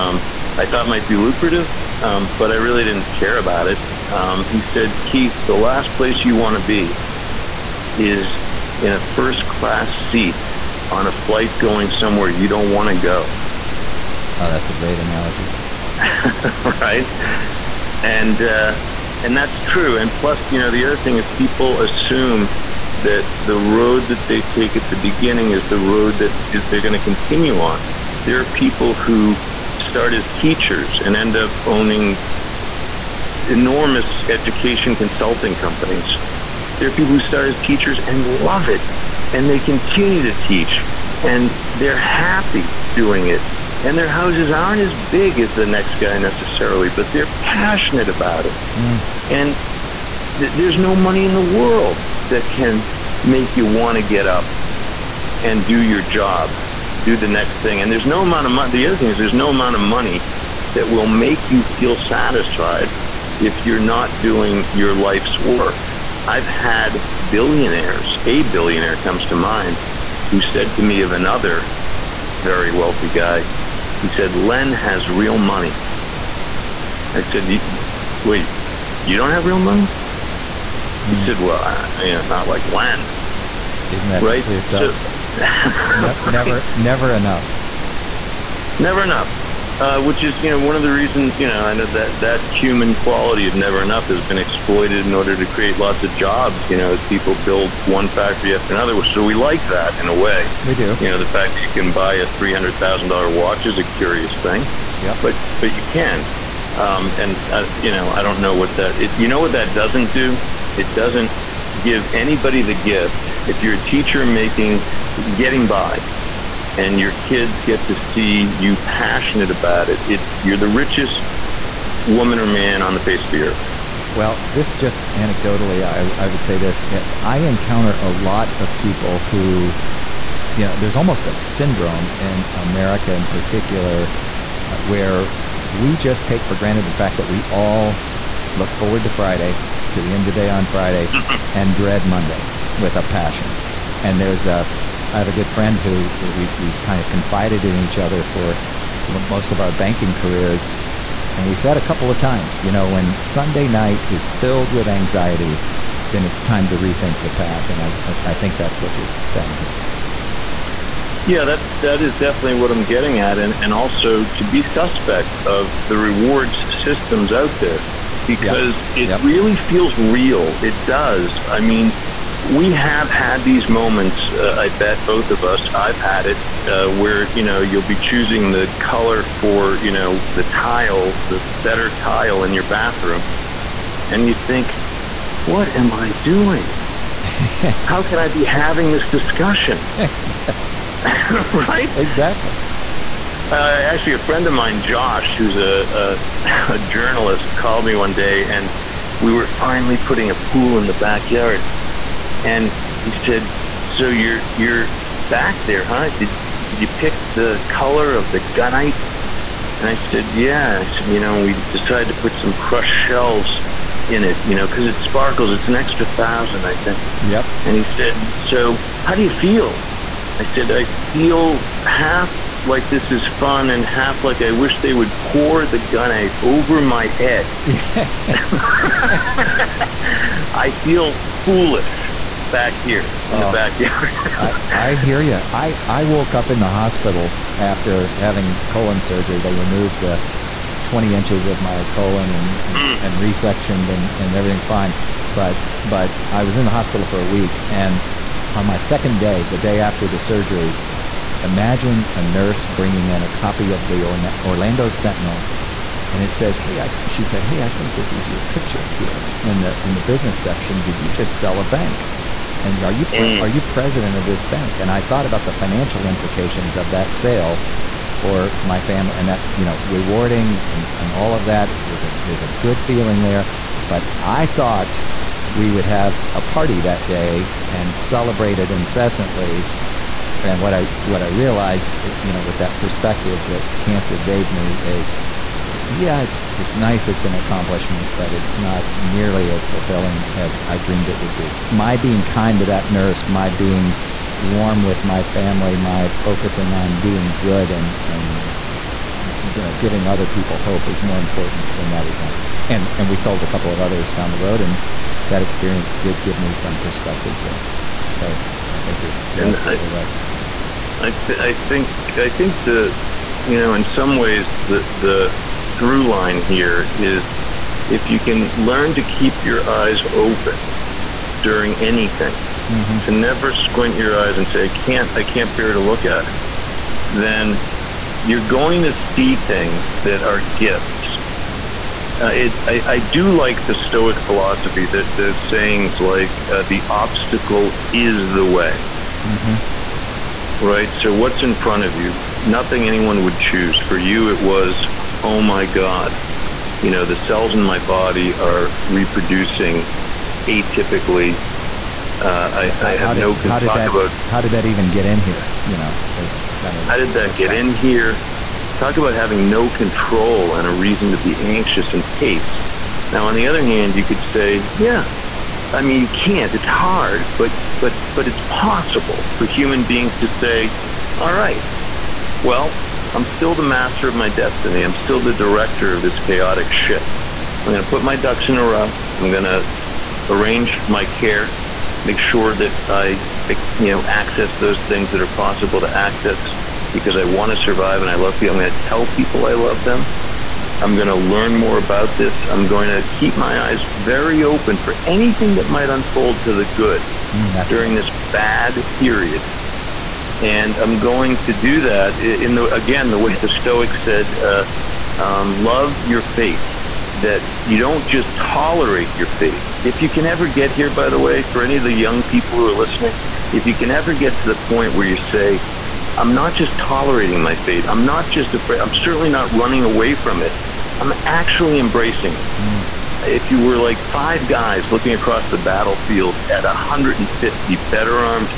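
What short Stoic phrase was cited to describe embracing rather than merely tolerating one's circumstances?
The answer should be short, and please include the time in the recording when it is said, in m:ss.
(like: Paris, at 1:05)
Love your fate, at 6:45.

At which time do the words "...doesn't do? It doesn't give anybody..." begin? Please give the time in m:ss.
1:49.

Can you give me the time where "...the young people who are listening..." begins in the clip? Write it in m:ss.
6:51.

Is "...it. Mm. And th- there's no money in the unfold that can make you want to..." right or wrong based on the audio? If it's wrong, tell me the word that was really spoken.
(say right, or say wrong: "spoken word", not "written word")
wrong: "world", not "unfold".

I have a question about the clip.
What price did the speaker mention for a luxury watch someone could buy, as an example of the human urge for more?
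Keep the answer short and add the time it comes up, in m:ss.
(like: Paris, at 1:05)
$300,000, at 1:42.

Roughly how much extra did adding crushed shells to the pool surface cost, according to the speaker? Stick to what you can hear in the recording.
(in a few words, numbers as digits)
$1,000.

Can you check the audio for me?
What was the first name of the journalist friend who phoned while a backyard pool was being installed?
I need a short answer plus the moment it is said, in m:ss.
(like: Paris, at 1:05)
Josh, at 3:14.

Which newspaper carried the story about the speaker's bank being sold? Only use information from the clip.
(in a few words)
Orlando Sentinel.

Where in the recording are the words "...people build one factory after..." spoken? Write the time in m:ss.
1:37.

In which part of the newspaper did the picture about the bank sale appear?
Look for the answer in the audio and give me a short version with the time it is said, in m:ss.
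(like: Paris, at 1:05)
Business section, at 4:19.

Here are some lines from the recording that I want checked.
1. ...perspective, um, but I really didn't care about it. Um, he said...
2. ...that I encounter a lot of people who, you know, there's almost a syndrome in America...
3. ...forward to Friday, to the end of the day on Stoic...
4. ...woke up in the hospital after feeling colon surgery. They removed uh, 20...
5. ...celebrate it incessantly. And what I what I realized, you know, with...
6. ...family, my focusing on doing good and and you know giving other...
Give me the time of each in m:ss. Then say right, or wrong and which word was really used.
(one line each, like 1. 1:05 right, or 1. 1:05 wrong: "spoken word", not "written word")
1. 0:01 wrong: "lucrative", not "perspective"
2. 2:06 right
3. 2:18 wrong: "Friday", not "Stoic"
4. 3:56 wrong: "having", not "feeling"
5. 4:37 right
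6. 4:55 right.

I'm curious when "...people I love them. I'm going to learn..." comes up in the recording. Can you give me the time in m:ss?
6:29.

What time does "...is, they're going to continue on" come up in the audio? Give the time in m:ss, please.
0:26.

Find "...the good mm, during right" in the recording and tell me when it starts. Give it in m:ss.
6:36.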